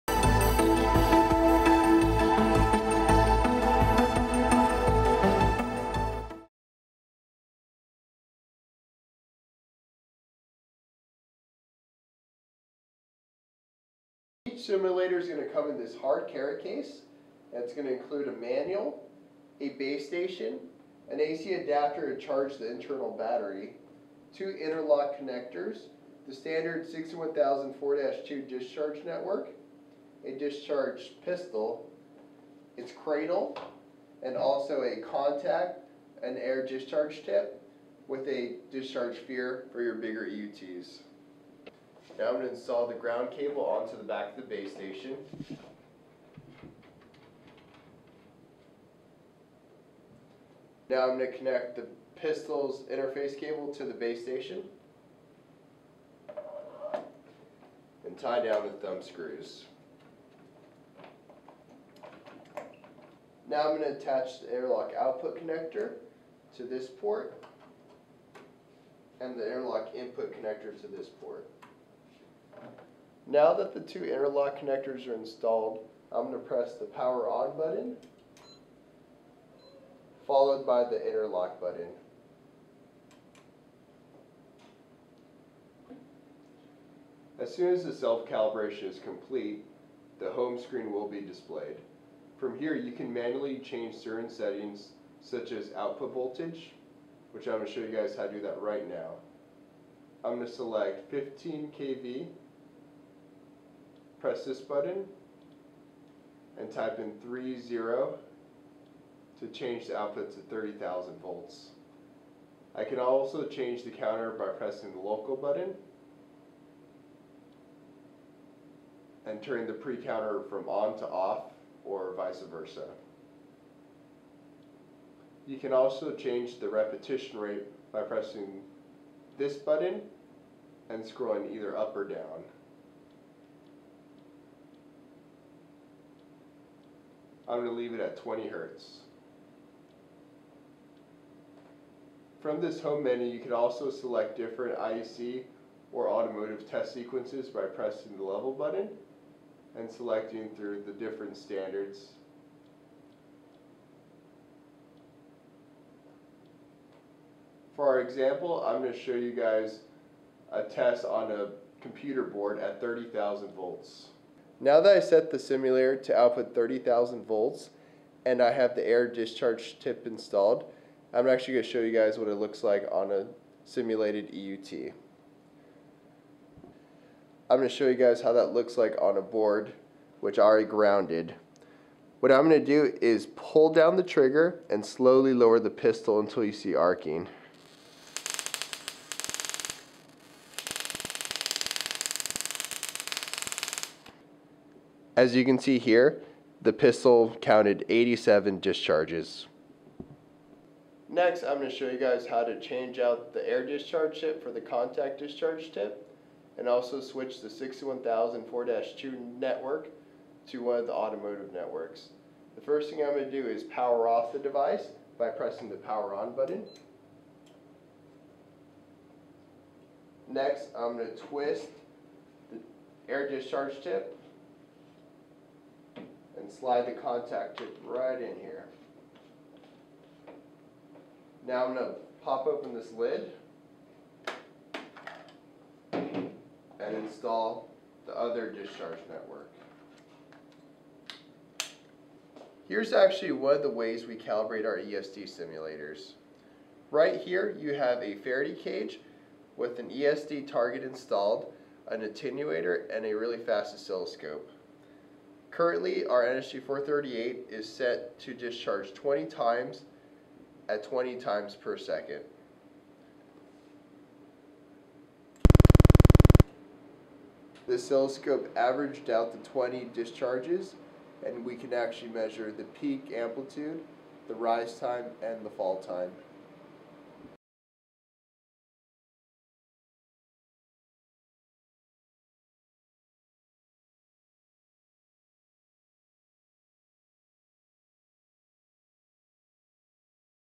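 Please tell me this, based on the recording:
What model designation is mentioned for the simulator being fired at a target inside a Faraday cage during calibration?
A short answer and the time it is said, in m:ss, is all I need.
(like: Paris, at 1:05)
NSG 438, at 4:16.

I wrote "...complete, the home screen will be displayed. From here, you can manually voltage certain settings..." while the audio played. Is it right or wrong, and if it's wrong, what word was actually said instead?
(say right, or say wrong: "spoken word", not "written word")
wrong: "change", not "voltage".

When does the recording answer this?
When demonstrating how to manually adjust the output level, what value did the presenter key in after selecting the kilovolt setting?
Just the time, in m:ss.
1:46.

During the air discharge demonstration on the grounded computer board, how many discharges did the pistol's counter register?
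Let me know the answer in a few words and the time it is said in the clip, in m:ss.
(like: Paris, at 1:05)
87, at 3:17.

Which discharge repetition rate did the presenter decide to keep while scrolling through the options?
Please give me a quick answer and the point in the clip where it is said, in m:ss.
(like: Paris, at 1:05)
20 hertz, at 2:18.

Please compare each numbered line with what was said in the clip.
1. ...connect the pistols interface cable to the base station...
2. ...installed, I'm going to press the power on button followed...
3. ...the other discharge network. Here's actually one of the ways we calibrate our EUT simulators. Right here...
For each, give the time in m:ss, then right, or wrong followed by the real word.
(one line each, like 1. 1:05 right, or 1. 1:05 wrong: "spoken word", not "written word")
1. 0:51 right
2. 1:15 right
3. 3:58 wrong: "ESD", not "EUT".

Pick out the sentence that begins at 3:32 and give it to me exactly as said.
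The first thing I'm going to do is power off the device by pressing the power on button.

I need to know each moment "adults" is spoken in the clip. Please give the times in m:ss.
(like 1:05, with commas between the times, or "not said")
not said.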